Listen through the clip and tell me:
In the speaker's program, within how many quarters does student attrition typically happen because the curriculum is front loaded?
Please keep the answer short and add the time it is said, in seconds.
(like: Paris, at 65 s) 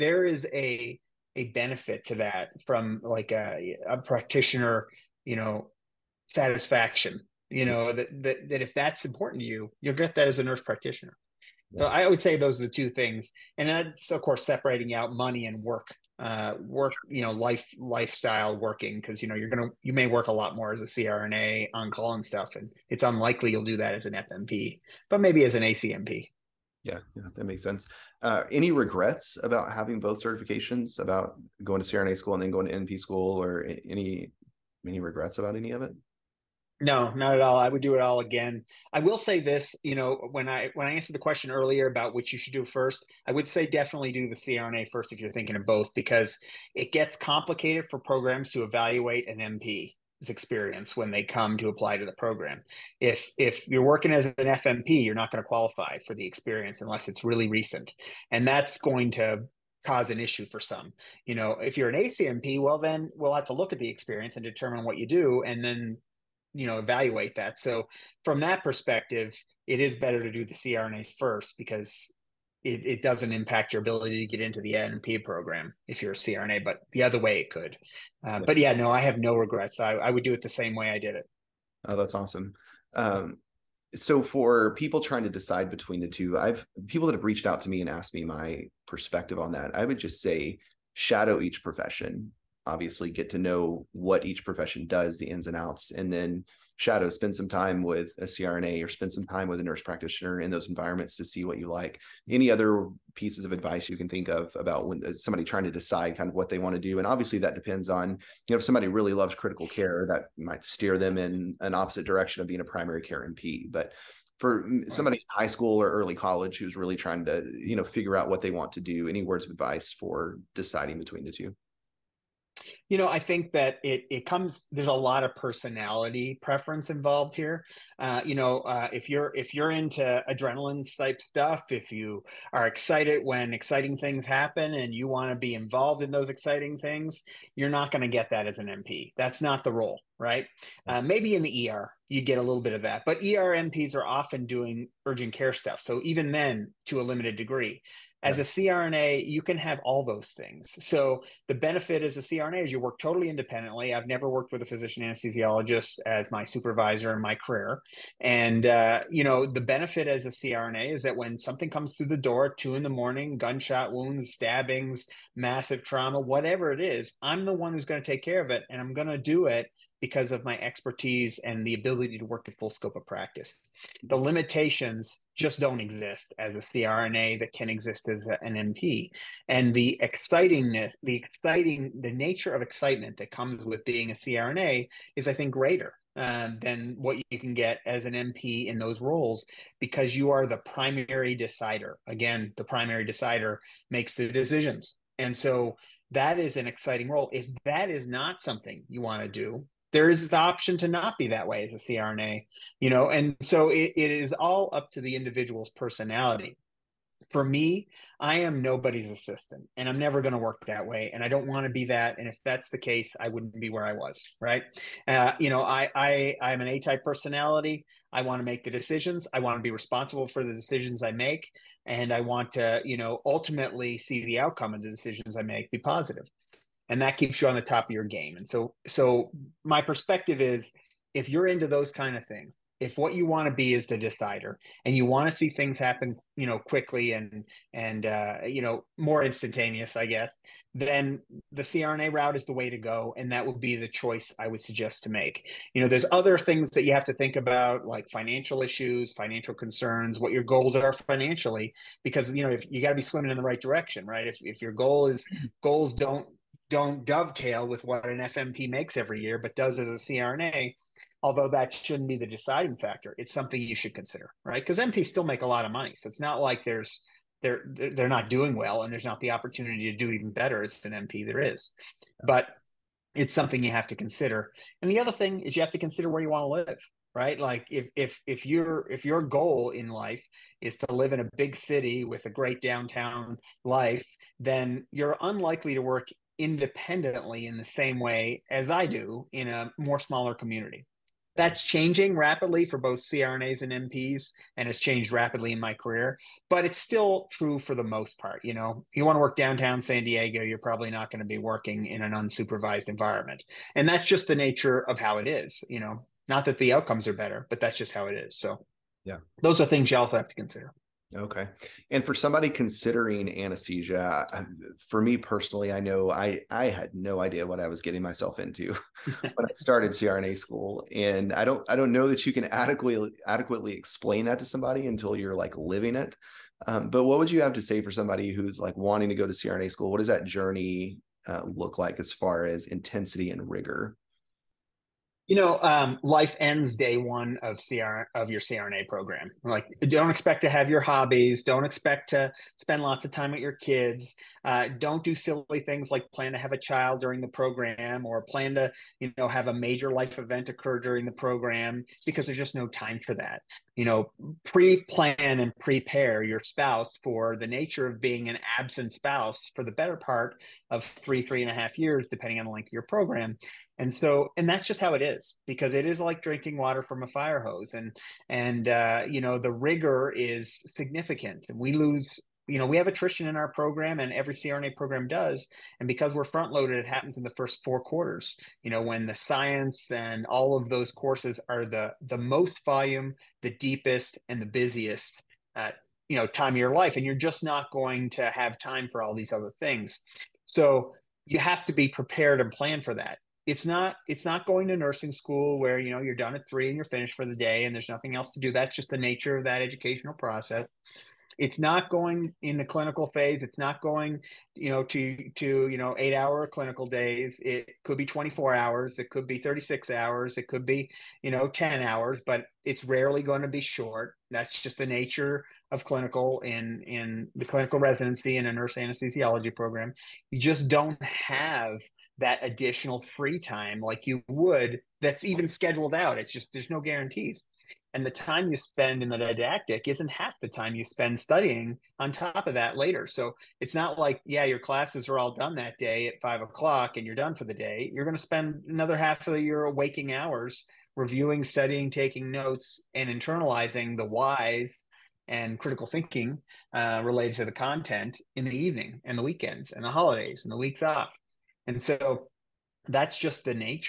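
first 4 quarters, at 377 s.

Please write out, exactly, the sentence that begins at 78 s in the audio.
Uh, but yeah, no, I have no regrets.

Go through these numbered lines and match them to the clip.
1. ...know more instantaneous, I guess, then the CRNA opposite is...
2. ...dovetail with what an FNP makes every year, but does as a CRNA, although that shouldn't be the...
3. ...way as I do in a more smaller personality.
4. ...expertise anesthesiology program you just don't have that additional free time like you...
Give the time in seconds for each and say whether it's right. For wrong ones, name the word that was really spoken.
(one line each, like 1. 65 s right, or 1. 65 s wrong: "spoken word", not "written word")
1. 238 s wrong: "route", not "opposite"
2. 257 s right
3. 287 s wrong: "community", not "personality"
4. 418 s wrong: "nurse", not "expertise".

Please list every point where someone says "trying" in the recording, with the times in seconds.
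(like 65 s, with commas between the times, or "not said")
84 s, 105 s, 116 s.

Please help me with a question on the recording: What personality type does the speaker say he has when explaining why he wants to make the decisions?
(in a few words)
A type personality.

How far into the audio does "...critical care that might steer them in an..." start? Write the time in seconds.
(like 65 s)
109 s.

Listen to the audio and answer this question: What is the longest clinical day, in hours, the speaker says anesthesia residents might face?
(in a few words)
36 hours.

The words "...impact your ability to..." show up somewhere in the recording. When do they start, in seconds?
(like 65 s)
73 s.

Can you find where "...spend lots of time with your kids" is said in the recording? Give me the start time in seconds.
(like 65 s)
342 s.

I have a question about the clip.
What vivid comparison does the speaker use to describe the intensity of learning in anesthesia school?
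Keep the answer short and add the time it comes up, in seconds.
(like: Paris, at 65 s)
drinking water from a fire hose, at 366 s.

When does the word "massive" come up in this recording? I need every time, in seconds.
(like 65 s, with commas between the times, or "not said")
165 s.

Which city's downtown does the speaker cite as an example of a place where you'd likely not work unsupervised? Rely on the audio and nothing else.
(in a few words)
San Diego.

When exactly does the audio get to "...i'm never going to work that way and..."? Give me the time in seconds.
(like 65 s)
209 s.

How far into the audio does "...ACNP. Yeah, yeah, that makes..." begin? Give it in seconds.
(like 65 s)
25 s.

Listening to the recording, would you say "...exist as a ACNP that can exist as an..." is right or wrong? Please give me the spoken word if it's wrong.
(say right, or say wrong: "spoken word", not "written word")
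wrong: "CRNA", not "ACNP".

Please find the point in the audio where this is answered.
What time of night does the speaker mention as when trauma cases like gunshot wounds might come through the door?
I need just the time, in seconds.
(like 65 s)
162 s.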